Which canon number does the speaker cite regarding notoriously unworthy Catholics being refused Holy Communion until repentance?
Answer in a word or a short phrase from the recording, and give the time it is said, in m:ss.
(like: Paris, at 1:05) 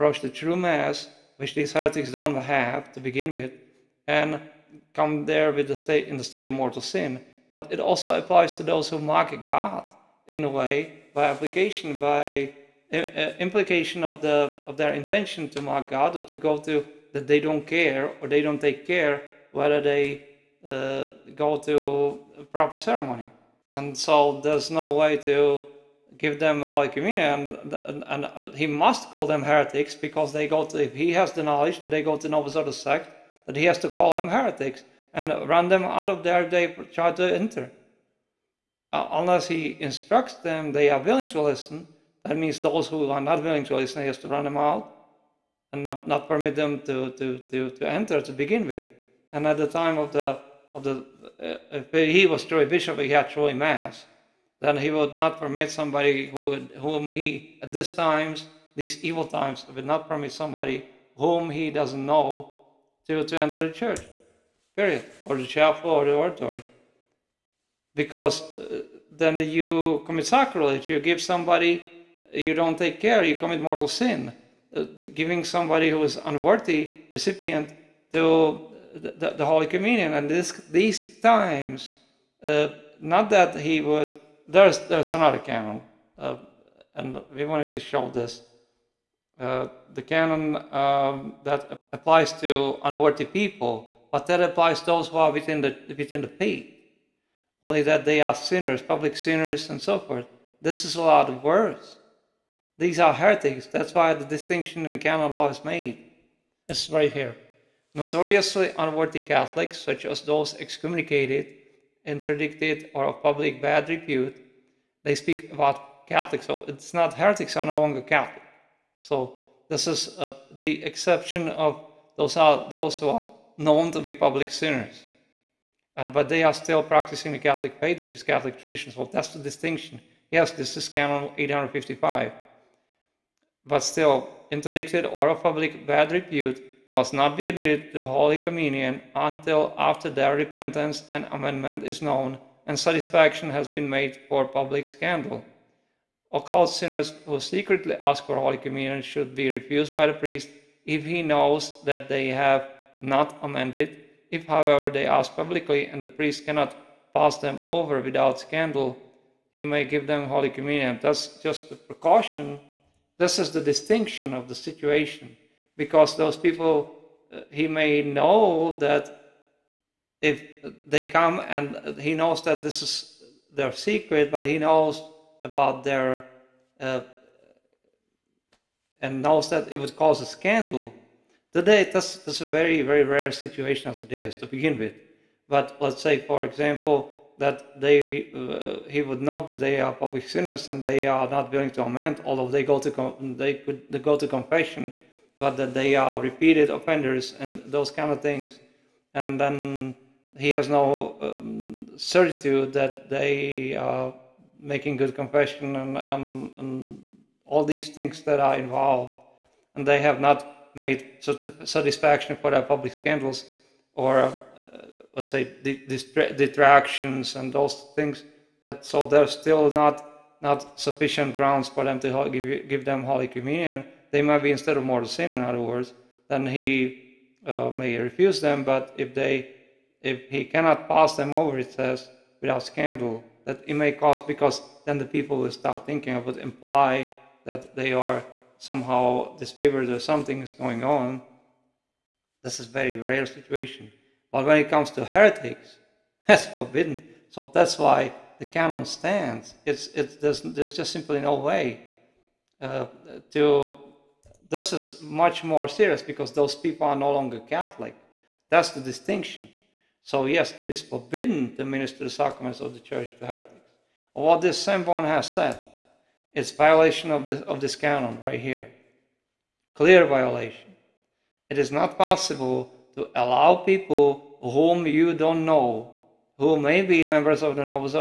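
Canon 855, at 2:10.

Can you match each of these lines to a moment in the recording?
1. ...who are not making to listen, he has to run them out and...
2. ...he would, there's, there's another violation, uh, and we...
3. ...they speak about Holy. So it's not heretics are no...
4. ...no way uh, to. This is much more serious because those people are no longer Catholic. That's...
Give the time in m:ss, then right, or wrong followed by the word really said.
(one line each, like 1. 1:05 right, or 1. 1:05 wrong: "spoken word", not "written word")
1. 0:42 wrong: "willing", not "making"
2. 1:23 wrong: "canon", not "violation"
3. 1:55 wrong: "Catholics", not "Holy"
4. 4:11 right.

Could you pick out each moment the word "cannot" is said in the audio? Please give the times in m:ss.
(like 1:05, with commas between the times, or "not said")
2:36, 3:50.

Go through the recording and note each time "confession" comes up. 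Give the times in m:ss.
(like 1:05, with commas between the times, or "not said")
3:14, 3:25.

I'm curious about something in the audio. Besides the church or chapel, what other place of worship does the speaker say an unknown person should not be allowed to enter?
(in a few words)
the oratory.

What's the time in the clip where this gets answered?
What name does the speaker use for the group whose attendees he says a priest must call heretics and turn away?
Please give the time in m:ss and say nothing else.
0:32.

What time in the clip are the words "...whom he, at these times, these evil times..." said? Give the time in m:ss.
0:56.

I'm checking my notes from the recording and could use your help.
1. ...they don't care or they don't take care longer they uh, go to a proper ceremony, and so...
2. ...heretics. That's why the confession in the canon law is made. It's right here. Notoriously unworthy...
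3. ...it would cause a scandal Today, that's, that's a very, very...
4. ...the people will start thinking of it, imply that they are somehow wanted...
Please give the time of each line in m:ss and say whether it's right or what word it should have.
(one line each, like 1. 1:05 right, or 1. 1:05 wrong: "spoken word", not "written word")
1. 0:17 wrong: "whether", not "longer"
2. 1:43 wrong: "distinction", not "confession"
3. 2:59 right
4. 3:54 wrong: "disfavored", not "wanted".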